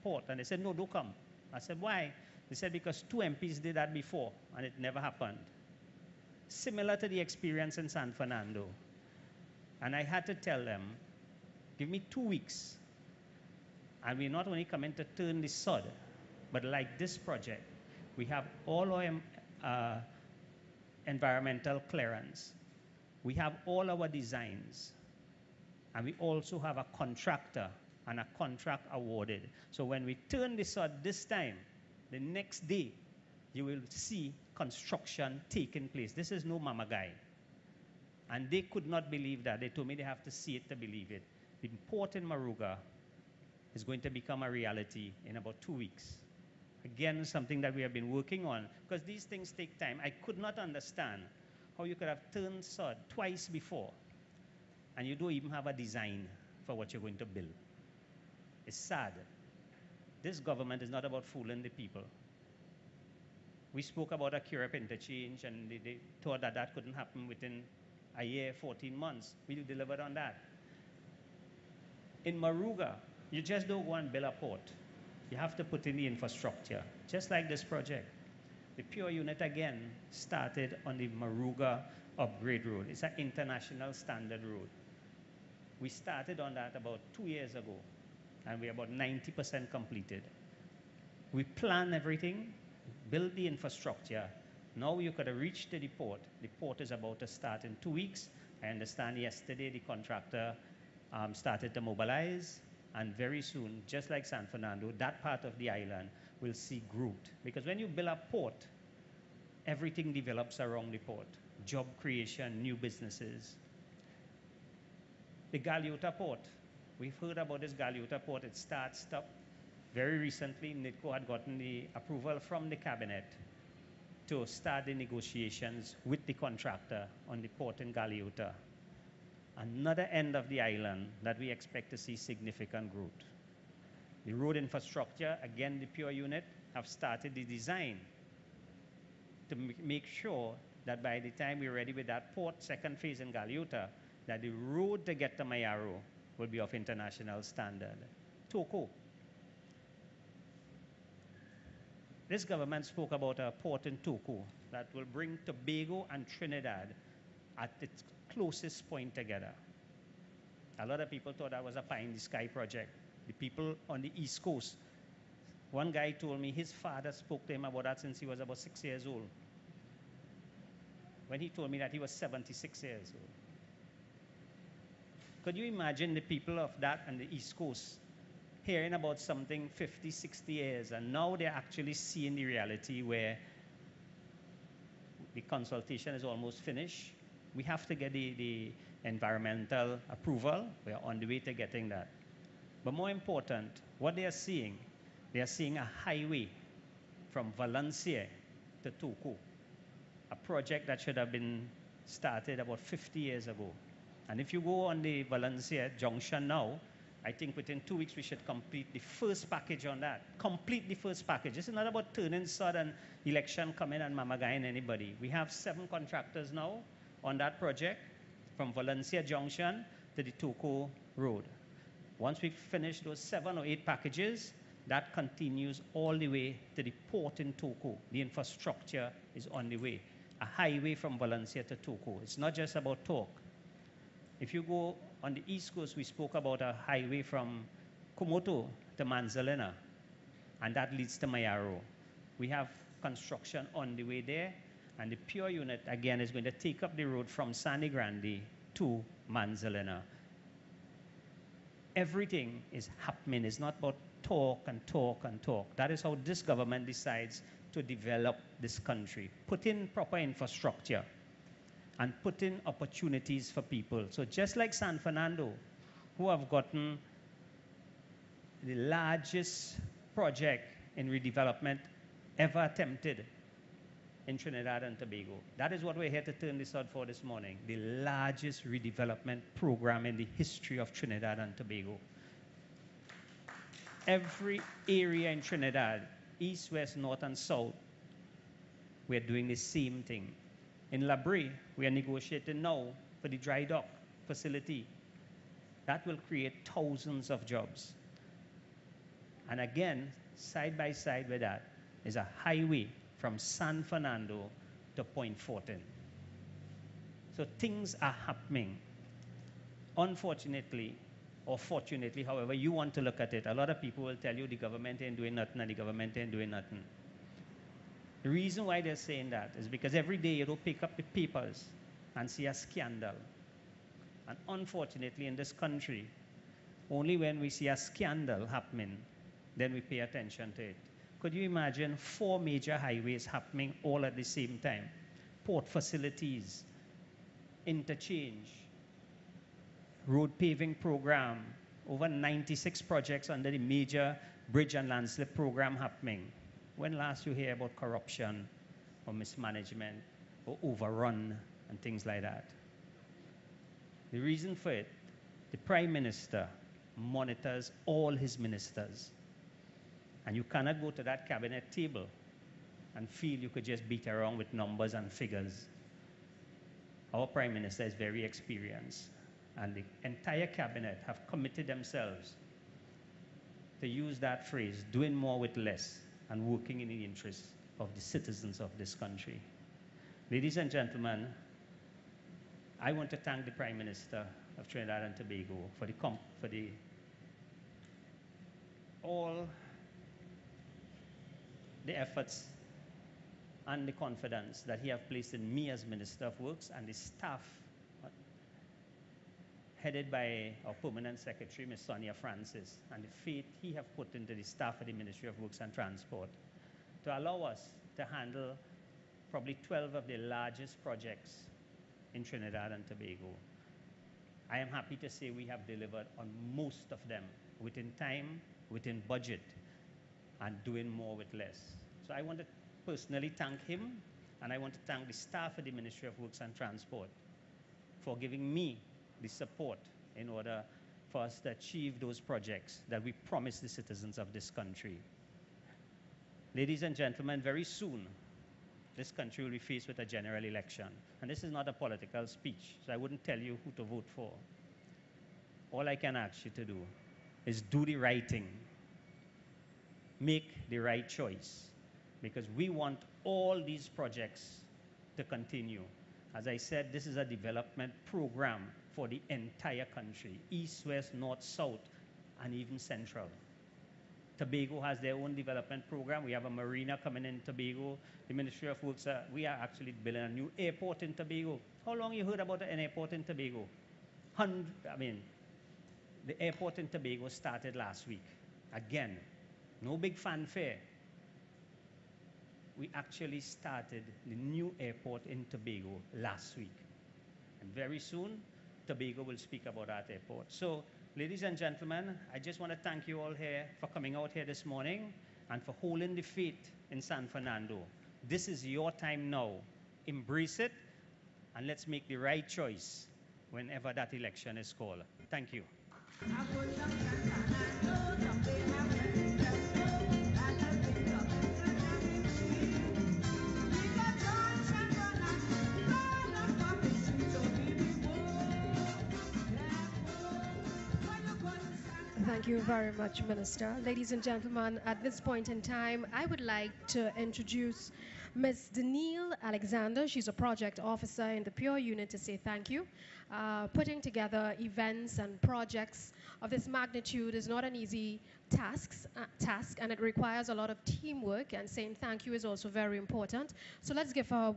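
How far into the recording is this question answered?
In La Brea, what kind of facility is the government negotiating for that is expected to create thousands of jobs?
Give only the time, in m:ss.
4:53.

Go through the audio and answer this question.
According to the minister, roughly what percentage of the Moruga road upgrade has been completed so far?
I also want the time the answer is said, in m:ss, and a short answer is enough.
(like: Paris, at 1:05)
90%, at 1:28.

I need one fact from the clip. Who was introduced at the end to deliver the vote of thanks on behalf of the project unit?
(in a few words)
Danielle Alexander.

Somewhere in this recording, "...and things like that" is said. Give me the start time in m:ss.
5:51.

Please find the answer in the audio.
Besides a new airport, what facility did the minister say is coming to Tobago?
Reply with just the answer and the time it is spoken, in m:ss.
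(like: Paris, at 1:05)
A marina, at 7:46.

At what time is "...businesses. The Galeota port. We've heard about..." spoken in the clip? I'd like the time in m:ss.
1:52.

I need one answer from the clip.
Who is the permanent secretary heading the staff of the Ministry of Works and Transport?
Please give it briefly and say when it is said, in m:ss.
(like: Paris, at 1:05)
Sonia Francis, at 6:41.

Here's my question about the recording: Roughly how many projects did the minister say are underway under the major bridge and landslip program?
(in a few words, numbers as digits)
96.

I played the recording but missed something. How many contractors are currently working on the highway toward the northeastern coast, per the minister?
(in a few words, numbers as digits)
7.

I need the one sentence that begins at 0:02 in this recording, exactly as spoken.
They said, Because two MPs did that before, and it never happened.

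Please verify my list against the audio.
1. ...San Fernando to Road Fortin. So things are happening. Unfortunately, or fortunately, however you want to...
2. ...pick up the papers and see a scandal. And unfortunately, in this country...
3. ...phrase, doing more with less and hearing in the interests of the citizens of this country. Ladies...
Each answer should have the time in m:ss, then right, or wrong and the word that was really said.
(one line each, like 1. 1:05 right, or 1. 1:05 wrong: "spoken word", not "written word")
1. 5:03 wrong: "Point", not "Road"
2. 5:20 right
3. 6:14 wrong: "working", not "hearing".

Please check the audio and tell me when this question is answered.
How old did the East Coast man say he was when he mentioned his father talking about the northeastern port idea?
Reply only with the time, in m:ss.
2:52.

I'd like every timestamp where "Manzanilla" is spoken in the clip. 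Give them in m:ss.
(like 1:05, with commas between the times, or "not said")
3:59, 4:09.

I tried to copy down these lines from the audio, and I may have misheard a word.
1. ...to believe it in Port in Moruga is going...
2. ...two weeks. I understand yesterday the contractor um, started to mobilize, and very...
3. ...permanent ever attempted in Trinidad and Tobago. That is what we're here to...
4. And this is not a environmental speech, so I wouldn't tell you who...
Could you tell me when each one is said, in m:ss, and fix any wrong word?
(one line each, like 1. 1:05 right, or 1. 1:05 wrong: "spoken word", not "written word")
1. 0:40 right
2. 1:37 right
3. 4:31 wrong: "redevelopment", not "permanent"
4. 7:21 wrong: "political", not "environmental".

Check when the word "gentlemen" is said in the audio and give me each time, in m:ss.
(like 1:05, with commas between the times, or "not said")
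6:20, 7:16, 8:11, 8:44.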